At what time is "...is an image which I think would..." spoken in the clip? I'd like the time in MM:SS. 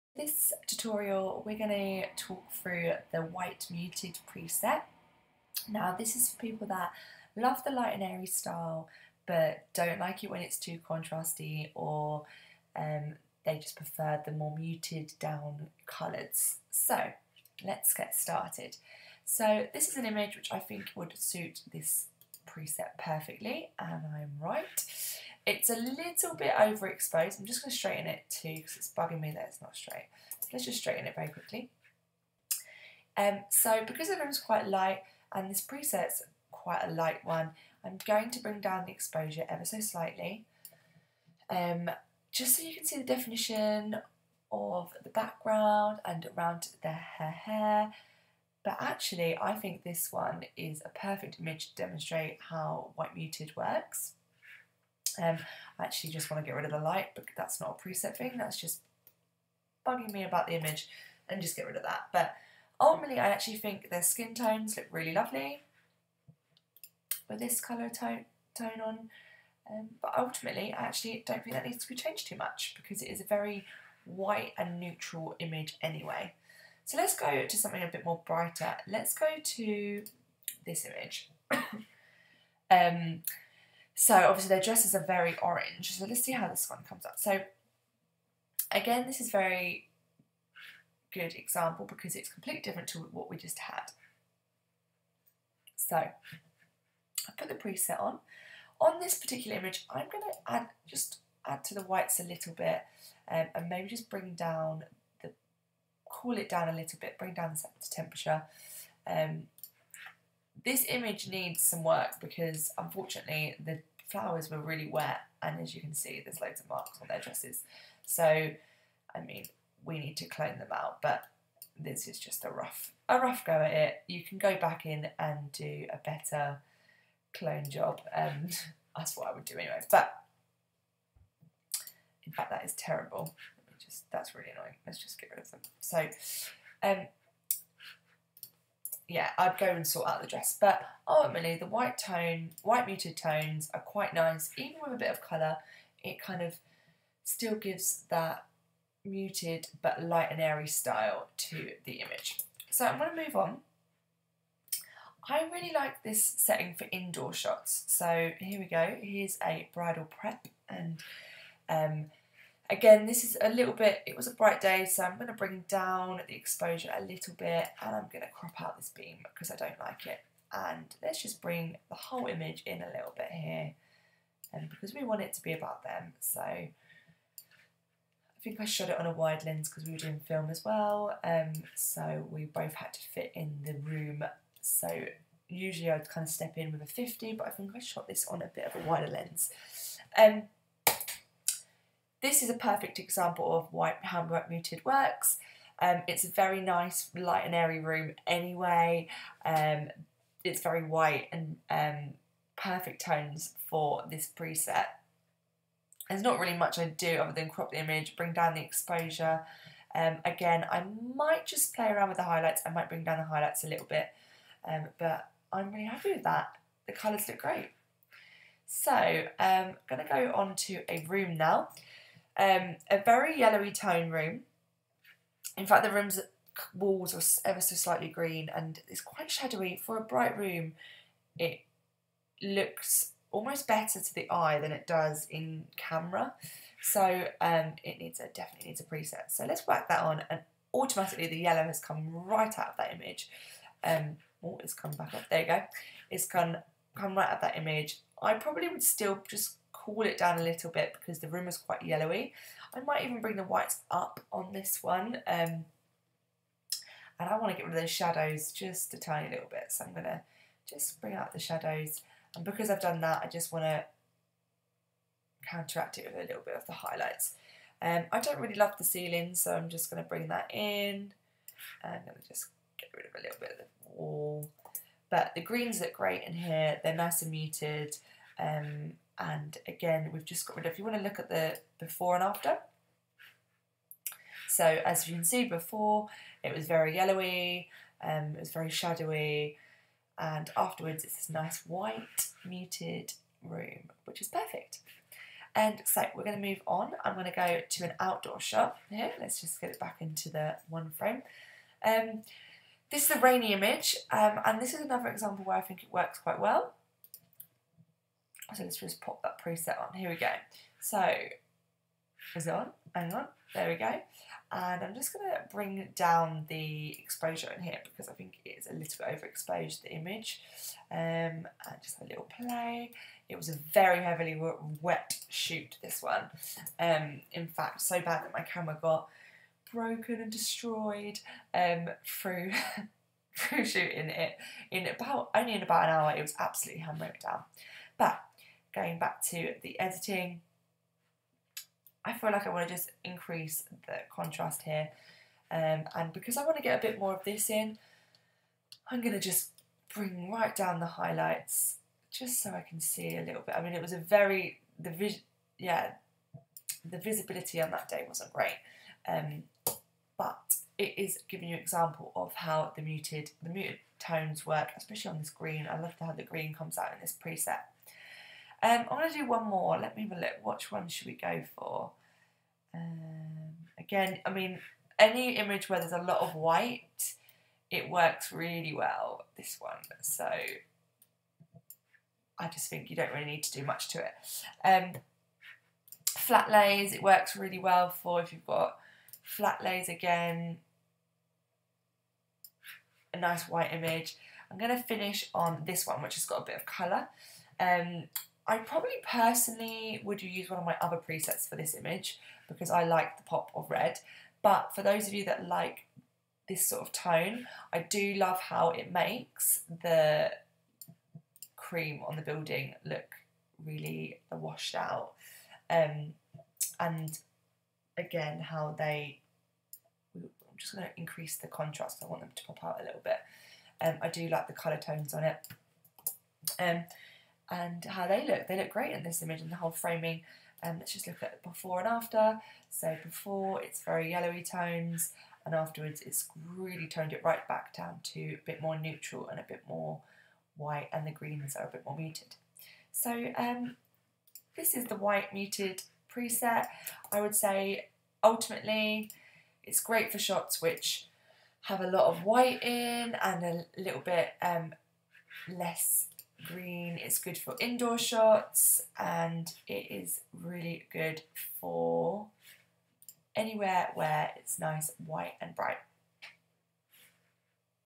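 00:19.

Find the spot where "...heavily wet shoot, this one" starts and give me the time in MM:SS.
05:24.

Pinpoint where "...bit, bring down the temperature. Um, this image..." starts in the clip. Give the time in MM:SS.
01:46.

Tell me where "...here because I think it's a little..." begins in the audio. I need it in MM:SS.
05:17.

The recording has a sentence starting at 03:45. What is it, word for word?
In fact, the room's walls were ever so slightly green and it's quite shadowy.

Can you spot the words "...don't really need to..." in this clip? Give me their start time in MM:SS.
06:22.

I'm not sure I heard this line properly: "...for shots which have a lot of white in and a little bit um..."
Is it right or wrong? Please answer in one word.
right.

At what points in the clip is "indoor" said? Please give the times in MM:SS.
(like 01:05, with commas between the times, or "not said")
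02:36, 07:37.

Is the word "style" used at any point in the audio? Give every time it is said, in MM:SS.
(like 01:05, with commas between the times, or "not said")
00:08, 02:30.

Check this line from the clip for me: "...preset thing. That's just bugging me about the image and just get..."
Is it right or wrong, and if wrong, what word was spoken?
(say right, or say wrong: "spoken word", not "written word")
right.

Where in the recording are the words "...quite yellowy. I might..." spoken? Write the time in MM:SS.
04:11.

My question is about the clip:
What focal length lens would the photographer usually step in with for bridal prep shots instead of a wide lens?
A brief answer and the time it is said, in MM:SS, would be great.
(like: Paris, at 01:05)
50, at 03:06.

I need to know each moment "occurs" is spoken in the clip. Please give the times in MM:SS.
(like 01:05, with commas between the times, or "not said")
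not said.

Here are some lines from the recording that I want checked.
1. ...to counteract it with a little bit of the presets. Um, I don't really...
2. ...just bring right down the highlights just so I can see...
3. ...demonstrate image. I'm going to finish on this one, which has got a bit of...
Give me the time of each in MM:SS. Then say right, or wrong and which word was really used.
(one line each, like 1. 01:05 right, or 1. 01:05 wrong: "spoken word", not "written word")
1. 04:23 wrong: "highlights", not "presets"
2. 05:49 right
3. 06:33 wrong: "white", not "demonstrate".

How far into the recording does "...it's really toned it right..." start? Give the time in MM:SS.
07:16.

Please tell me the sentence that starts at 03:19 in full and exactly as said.
Um, it's very white and um, perfect tones for this preset.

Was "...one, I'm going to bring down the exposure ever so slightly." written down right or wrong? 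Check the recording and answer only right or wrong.
right.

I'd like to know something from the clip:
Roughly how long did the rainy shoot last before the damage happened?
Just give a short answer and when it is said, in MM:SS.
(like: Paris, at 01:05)
About an hour, at 05:35.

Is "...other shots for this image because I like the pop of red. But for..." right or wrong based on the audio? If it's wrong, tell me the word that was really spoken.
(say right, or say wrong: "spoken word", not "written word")
wrong: "presets", not "shots".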